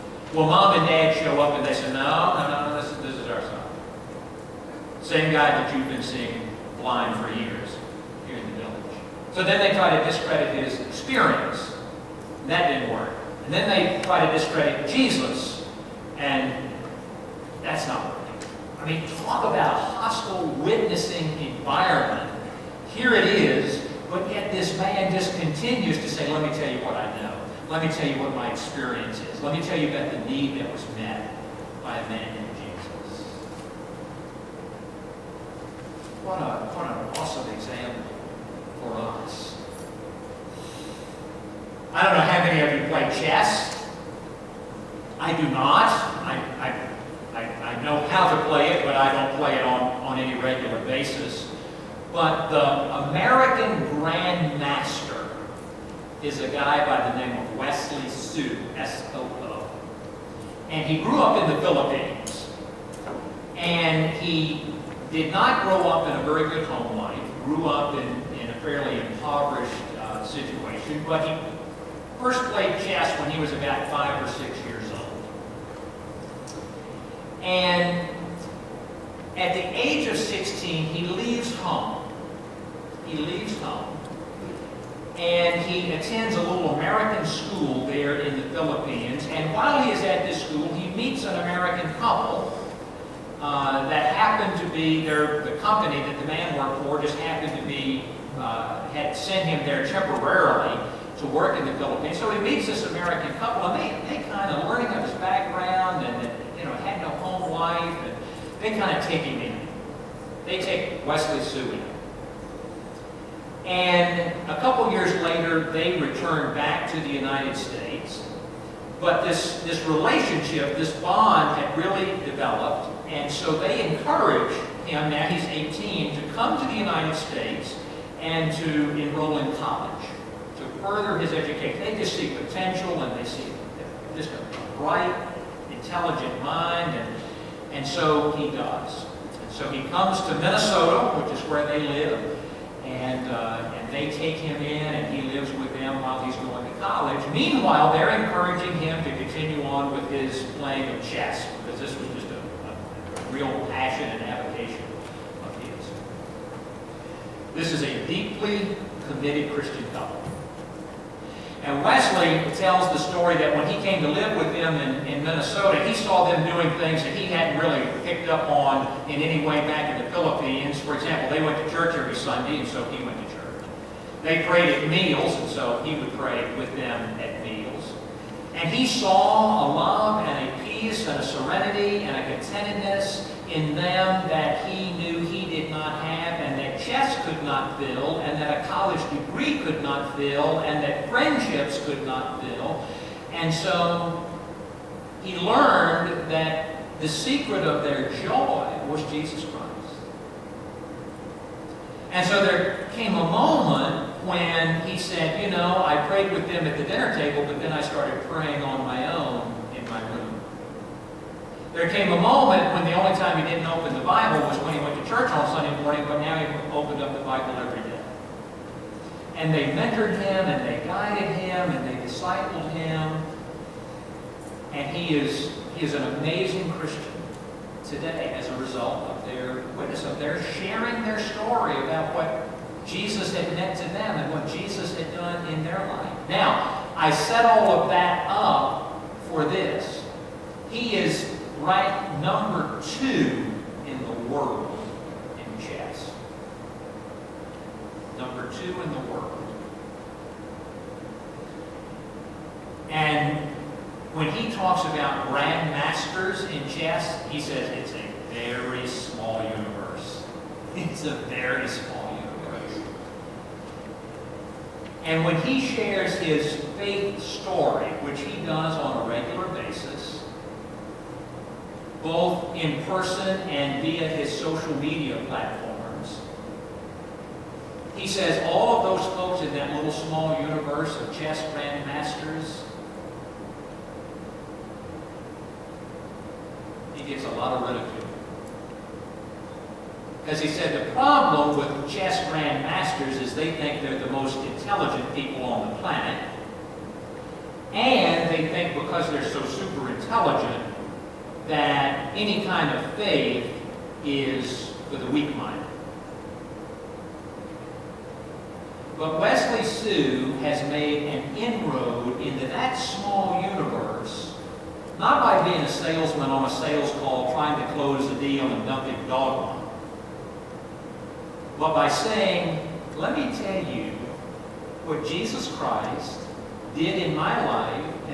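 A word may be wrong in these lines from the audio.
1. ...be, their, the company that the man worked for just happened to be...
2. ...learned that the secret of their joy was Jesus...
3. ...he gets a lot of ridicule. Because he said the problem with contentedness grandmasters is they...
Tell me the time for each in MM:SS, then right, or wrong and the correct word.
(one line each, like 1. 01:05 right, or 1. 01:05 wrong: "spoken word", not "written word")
1. 01:34 right
2. 03:15 right
3. 04:46 wrong: "chess", not "contentedness".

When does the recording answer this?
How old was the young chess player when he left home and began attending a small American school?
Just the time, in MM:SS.
01:20.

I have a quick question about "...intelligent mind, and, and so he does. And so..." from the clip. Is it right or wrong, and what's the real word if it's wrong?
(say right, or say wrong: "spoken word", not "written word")
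right.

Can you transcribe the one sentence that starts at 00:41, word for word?
I don't know how many of you play chess.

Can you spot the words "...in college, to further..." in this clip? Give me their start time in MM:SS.
02:09.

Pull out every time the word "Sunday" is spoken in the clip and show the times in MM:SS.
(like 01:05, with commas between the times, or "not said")
02:52, 03:35.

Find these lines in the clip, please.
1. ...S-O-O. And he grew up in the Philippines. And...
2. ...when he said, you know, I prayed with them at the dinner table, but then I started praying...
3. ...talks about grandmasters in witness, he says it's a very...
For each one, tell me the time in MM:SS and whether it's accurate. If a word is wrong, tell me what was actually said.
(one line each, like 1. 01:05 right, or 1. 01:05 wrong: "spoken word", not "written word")
1. 00:58 right
2. 03:24 right
3. 04:14 wrong: "chess", not "witness".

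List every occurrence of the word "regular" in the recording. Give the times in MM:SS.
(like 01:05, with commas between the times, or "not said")
00:50, 04:29.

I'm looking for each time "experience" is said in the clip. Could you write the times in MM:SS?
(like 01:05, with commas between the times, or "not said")
00:10, 00:28.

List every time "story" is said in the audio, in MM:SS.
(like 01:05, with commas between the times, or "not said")
02:42, 03:51, 04:27.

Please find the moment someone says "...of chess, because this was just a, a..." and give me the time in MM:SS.
02:30.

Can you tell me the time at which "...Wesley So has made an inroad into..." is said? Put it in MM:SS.
05:09.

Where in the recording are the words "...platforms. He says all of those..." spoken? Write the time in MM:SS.
04:35.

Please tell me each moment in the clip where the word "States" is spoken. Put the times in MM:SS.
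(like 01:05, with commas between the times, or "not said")
01:57, 02:07.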